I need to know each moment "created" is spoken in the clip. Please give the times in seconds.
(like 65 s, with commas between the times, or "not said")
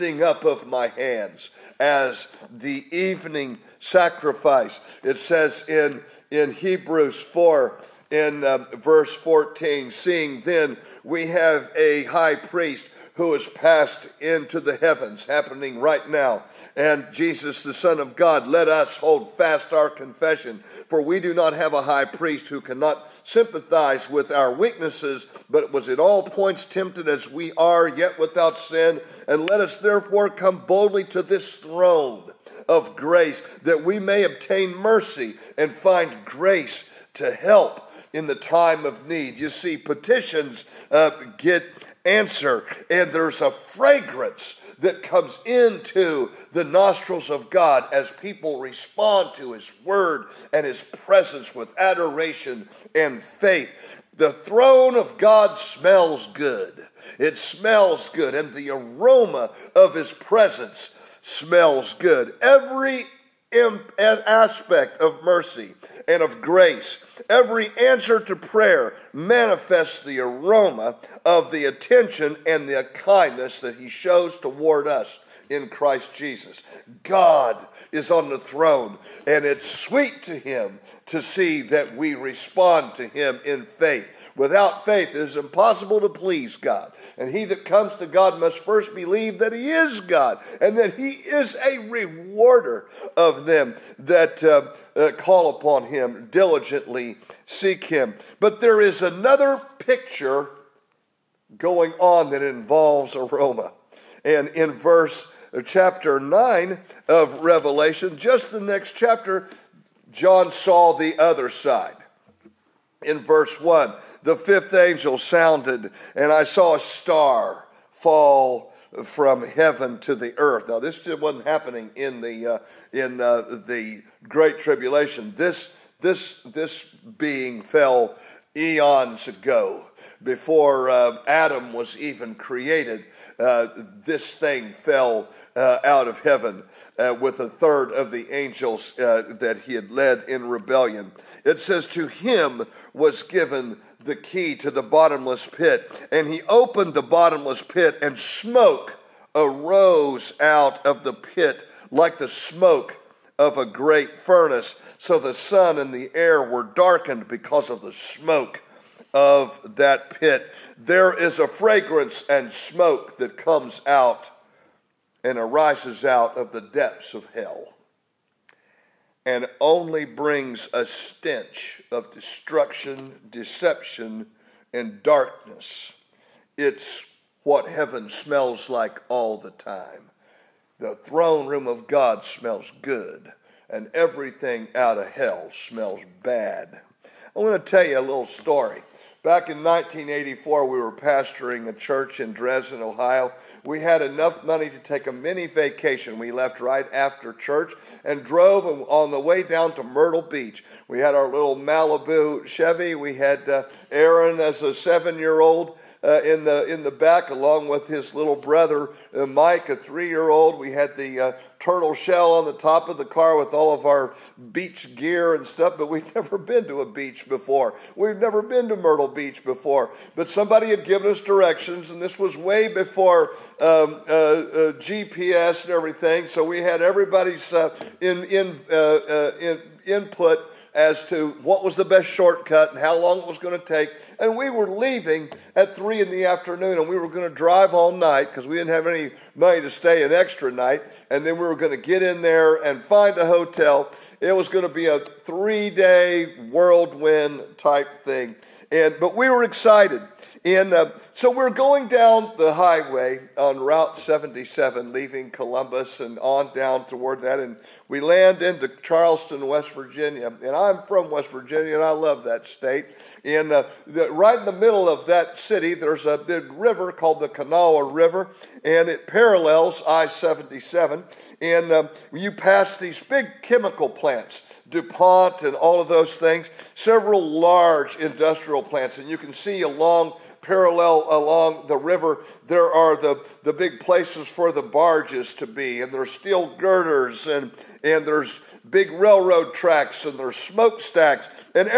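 132 s.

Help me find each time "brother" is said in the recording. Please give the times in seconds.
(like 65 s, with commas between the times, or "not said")
208 s.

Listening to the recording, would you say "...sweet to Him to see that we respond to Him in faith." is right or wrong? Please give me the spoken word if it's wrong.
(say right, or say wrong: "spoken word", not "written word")
right.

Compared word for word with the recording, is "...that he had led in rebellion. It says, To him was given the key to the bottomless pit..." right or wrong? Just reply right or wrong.
right.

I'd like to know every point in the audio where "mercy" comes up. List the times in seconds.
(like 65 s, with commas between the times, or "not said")
34 s, 65 s.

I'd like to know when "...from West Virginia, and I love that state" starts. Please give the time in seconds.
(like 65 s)
260 s.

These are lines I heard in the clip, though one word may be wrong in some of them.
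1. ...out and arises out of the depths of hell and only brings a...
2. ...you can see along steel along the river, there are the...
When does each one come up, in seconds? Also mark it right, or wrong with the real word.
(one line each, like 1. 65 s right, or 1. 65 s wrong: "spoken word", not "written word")
1. 163 s right
2. 279 s wrong: "parallel", not "steel".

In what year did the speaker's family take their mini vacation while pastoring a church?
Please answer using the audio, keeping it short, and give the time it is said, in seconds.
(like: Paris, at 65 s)
1984, at 189 s.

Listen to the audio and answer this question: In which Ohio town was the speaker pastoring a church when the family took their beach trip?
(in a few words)
Dresden.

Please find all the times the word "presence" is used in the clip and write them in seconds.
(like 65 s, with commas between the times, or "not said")
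50 s, 60 s.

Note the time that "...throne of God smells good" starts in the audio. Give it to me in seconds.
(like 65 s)
54 s.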